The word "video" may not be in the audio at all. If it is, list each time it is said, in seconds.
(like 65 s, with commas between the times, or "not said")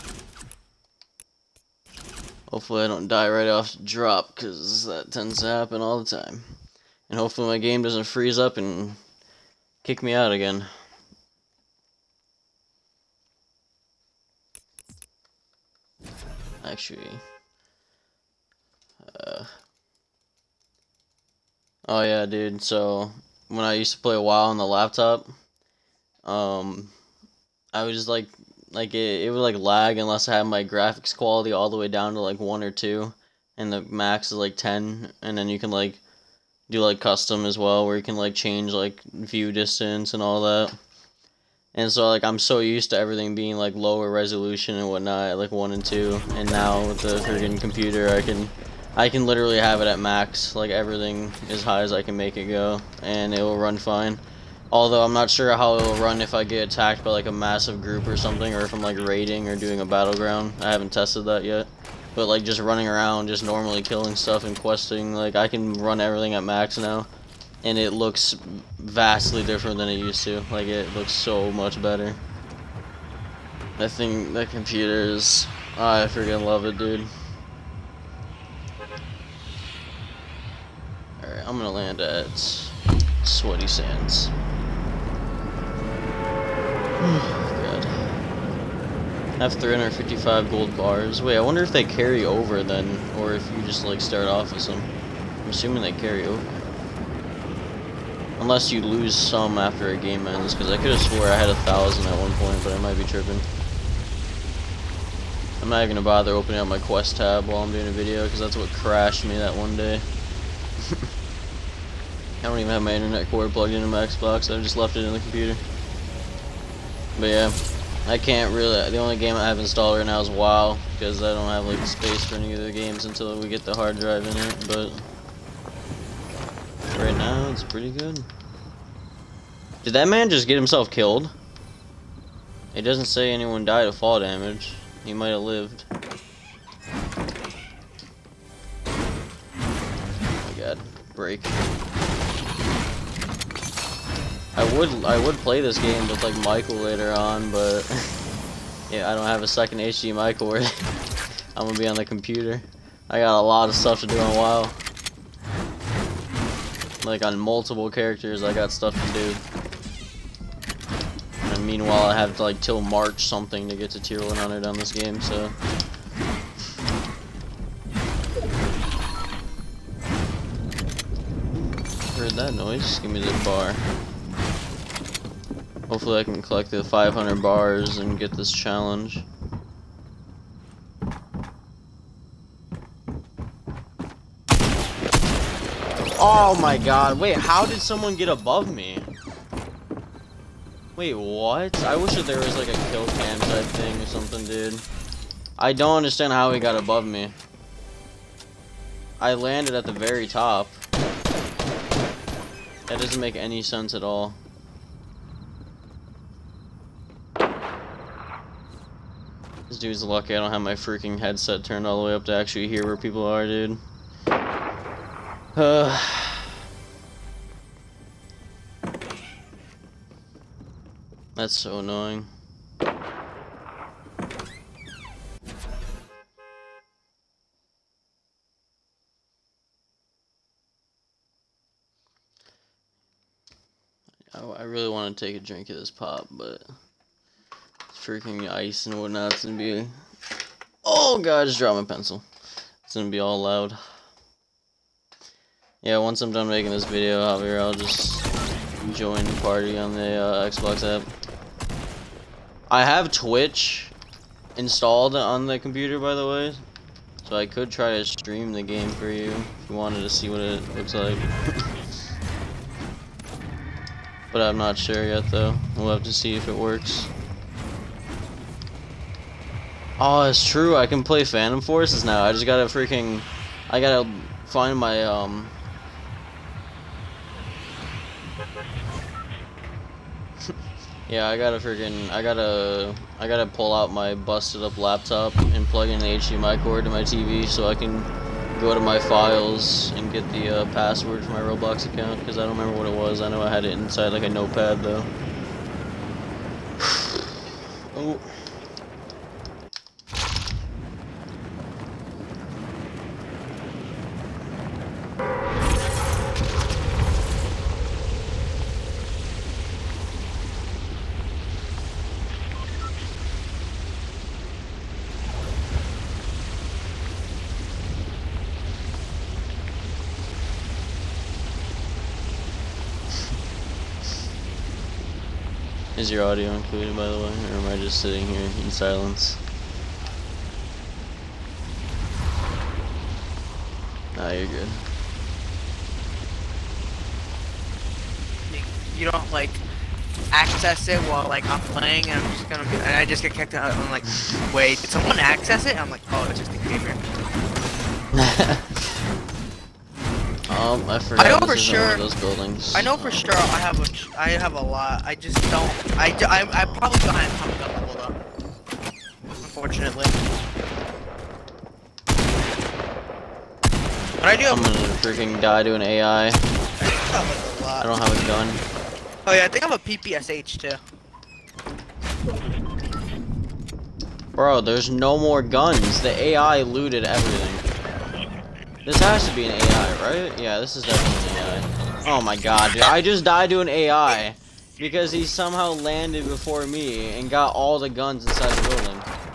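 107 s, 246 s.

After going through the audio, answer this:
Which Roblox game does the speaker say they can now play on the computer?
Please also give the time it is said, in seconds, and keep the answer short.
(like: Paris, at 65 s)
Phantom Forces, at 271 s.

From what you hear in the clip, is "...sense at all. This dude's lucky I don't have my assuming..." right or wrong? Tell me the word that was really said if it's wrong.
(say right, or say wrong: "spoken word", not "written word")
wrong: "freaking", not "assuming".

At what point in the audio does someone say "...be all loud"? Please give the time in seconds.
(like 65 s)
243 s.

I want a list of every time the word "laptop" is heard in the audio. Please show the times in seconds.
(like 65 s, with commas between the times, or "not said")
24 s, 284 s.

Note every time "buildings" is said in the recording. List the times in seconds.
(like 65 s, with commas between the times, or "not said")
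352 s, 388 s.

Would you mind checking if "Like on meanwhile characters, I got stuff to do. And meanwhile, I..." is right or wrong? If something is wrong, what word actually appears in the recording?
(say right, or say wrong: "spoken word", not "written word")
wrong: "multiple", not "meanwhile".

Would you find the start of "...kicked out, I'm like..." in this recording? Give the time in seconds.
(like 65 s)
343 s.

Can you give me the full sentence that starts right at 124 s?
But right now, it's pretty good.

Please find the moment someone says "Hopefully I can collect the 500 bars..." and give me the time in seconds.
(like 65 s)
175 s.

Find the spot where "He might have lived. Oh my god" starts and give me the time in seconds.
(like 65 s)
135 s.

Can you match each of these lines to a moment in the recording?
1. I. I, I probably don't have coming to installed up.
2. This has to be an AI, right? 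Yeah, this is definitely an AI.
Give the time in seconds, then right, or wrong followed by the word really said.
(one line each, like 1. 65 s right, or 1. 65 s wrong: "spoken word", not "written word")
1. 355 s wrong: "leveled", not "installed"
2. 378 s right.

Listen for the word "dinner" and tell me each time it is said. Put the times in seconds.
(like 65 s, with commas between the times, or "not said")
not said.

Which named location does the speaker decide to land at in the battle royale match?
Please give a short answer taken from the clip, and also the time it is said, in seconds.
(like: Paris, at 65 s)
Sweaty Sands, at 83 s.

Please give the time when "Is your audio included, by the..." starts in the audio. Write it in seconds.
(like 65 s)
326 s.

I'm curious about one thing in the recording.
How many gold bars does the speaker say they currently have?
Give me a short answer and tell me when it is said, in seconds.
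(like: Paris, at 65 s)
355, at 89 s.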